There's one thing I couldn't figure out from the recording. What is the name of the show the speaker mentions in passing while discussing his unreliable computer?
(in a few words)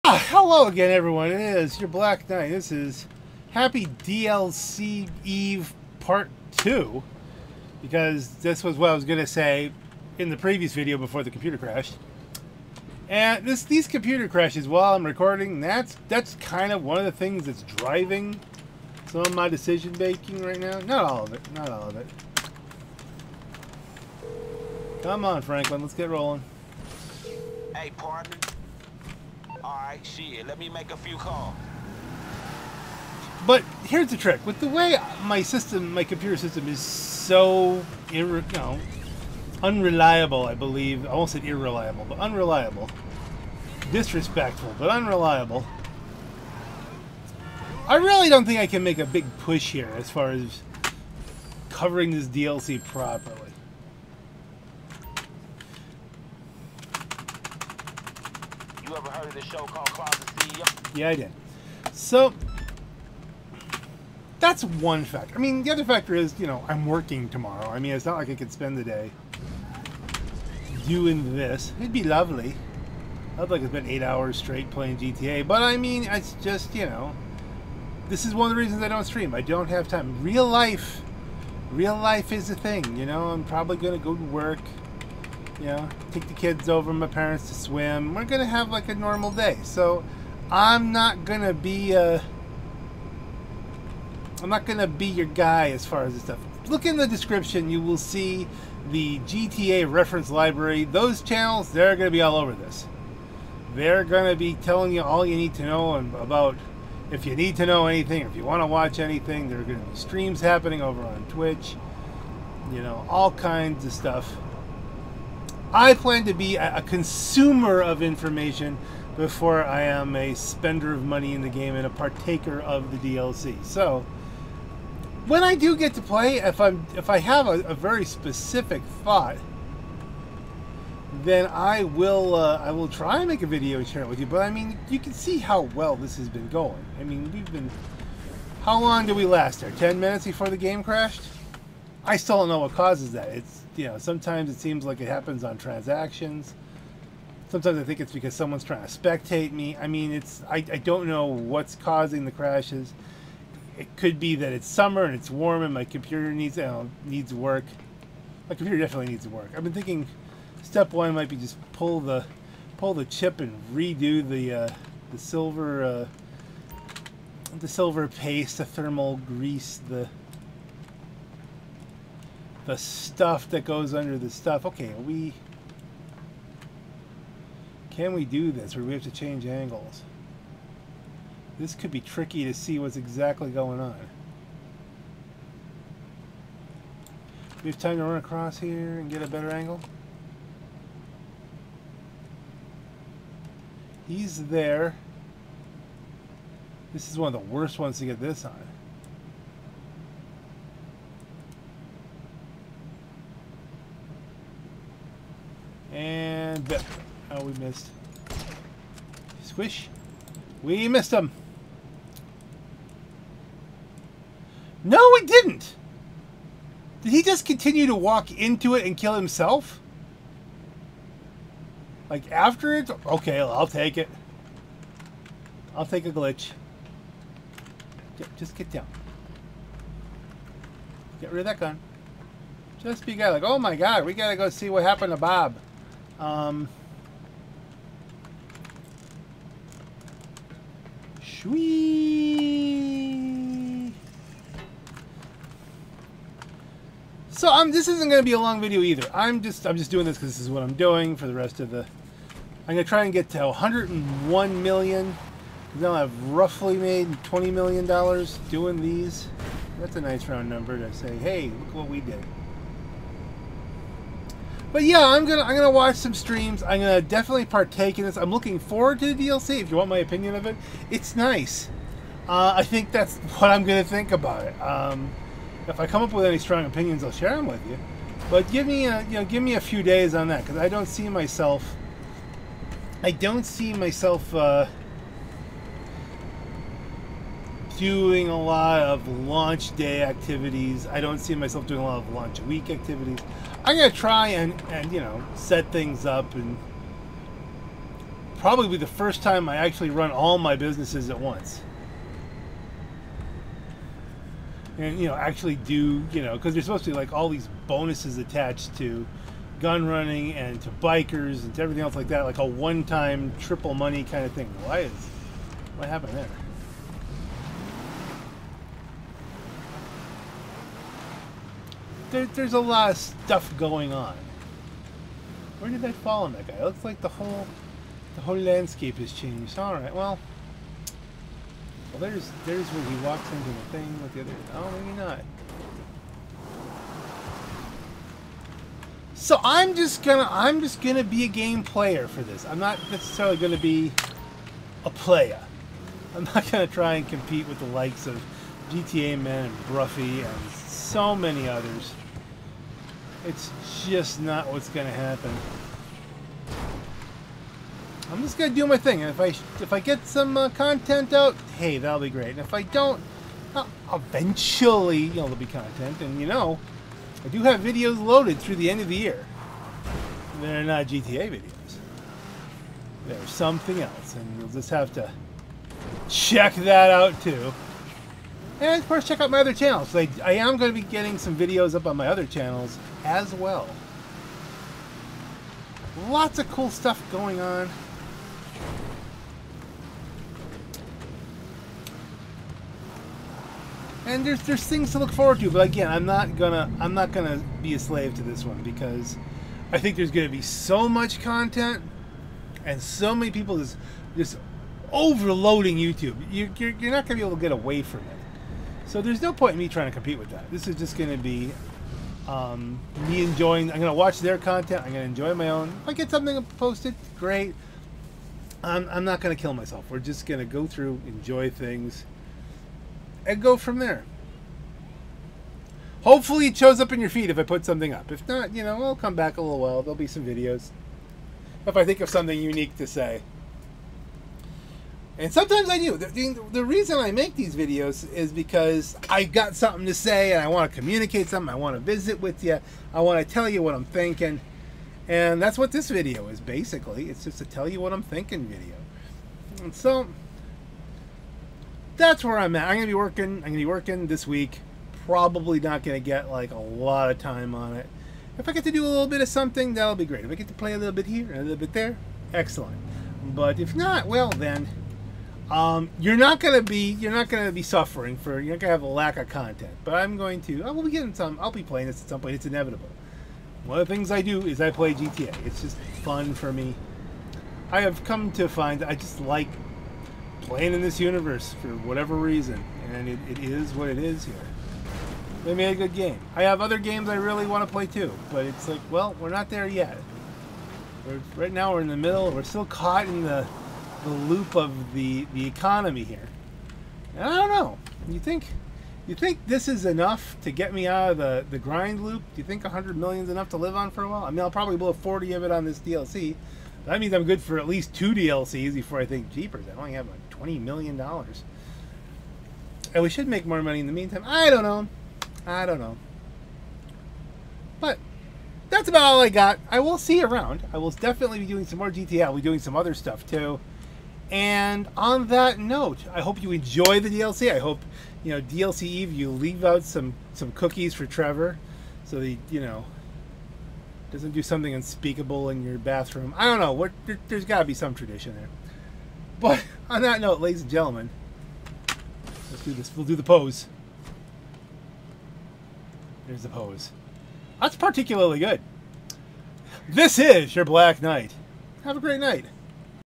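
Closet CEO.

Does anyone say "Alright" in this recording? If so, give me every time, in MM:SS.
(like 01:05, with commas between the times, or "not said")
00:29.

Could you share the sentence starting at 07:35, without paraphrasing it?
Probably not going to get like a lot of time on it.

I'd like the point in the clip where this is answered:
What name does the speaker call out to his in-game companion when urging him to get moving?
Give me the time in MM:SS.
00:25.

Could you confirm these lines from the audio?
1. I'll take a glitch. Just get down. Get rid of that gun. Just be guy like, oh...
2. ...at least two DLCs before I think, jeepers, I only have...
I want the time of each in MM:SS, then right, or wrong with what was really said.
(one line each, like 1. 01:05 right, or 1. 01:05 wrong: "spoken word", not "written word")
1. 03:45 right
2. 08:27 right.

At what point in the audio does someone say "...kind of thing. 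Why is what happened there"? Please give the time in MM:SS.
05:14.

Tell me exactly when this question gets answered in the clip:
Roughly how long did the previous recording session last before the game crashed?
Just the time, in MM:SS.
02:19.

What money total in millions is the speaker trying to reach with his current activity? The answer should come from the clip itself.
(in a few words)
101 million.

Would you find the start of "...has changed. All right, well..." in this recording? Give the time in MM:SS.
05:28.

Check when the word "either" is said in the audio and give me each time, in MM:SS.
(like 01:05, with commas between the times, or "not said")
04:08.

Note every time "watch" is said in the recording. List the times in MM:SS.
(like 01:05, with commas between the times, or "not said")
01:48, 04:25, 06:53.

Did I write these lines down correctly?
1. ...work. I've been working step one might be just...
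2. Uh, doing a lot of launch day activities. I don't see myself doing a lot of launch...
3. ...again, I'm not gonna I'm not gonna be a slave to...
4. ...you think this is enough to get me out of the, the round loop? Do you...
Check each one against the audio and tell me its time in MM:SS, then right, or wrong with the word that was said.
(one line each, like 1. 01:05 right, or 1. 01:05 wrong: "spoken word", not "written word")
1. 02:39 wrong: "thinking", not "working"
2. 04:44 right
3. 06:35 right
4. 08:19 wrong: "grind", not "round".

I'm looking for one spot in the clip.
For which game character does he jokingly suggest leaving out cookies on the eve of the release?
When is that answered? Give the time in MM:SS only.
08:51.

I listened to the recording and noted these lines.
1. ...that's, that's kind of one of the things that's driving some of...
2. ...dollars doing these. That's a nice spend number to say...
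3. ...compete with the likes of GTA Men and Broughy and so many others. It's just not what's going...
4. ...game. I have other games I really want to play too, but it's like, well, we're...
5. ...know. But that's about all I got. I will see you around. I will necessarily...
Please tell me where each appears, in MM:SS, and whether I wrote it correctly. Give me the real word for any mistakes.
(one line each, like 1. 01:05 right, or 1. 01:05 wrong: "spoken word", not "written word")
1. 00:15 right
2. 04:17 wrong: "round", not "spend"
3. 05:47 right
4. 08:05 right
5. 08:35 wrong: "definitely", not "necessarily".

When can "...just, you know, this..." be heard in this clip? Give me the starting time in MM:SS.
01:16.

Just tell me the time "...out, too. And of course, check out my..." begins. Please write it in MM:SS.
06:16.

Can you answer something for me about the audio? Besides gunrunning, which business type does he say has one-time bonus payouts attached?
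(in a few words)
bikers.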